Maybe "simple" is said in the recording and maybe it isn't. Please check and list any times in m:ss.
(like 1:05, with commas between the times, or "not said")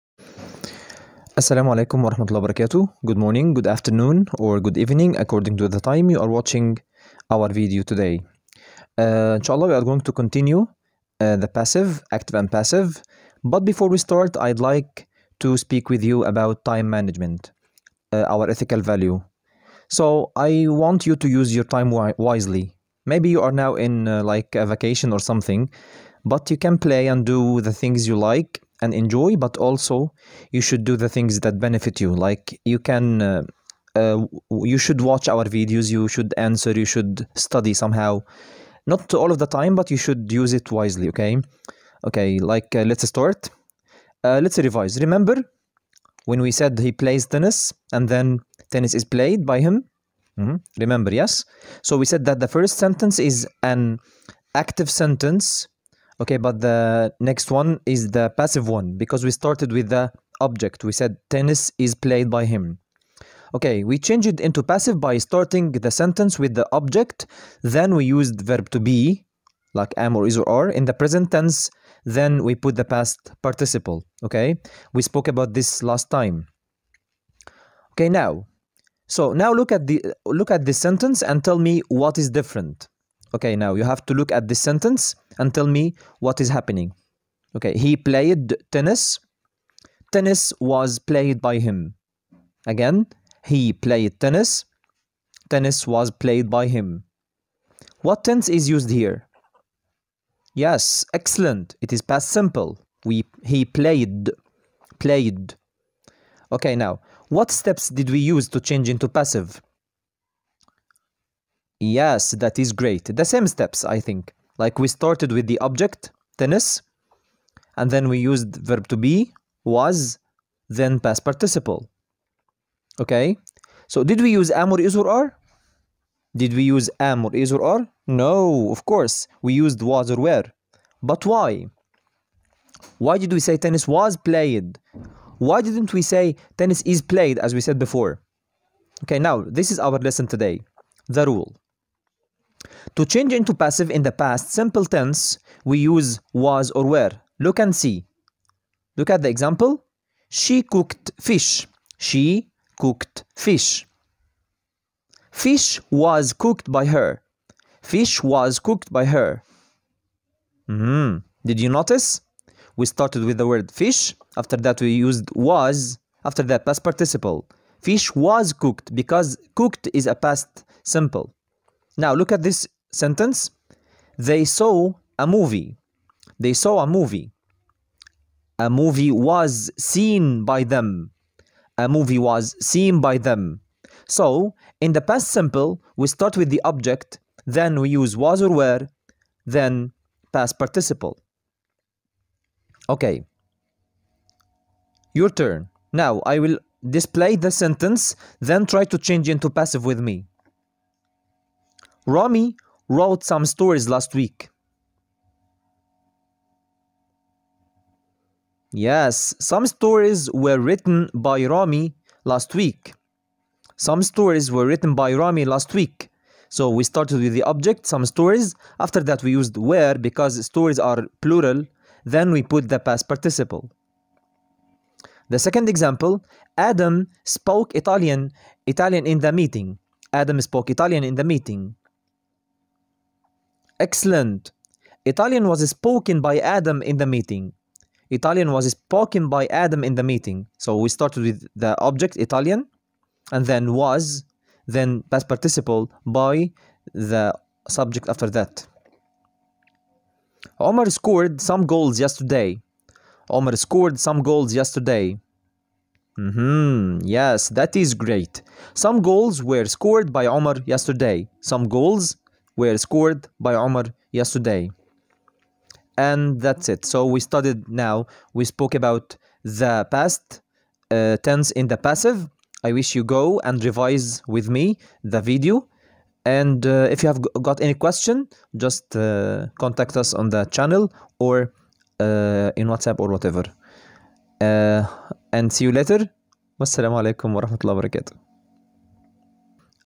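1:42, 2:24, 2:50, 3:05.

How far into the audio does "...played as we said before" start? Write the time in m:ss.
2:17.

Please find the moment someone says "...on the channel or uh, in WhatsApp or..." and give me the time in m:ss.
4:40.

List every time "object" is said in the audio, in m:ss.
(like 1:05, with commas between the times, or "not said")
1:00, 1:06, 1:55, 3:06, 3:37, 4:01.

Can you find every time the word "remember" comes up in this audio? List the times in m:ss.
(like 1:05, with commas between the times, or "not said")
0:44, 0:50.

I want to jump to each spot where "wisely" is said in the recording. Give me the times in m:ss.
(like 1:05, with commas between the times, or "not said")
0:22, 0:40.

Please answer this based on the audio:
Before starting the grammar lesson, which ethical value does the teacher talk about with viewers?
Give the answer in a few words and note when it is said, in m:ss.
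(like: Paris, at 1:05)
Time management, at 0:16.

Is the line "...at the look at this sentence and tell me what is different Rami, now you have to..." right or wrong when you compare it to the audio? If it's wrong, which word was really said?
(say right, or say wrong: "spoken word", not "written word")
wrong: "Okay", not "Rami".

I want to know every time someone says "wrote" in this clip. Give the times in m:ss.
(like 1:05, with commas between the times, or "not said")
3:22.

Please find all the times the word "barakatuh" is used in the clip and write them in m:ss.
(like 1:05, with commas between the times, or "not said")
0:02, 4:47.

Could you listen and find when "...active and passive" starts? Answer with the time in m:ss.
0:12.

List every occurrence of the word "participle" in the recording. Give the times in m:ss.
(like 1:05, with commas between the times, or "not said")
1:13, 2:01, 2:46, 3:10, 3:43, 4:05.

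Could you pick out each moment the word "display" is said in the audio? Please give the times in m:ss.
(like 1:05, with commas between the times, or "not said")
3:16.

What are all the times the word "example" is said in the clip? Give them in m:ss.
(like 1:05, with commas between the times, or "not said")
2:29, 3:45.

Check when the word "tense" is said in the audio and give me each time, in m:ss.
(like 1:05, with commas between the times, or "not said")
1:11, 1:38, 2:24, 4:31.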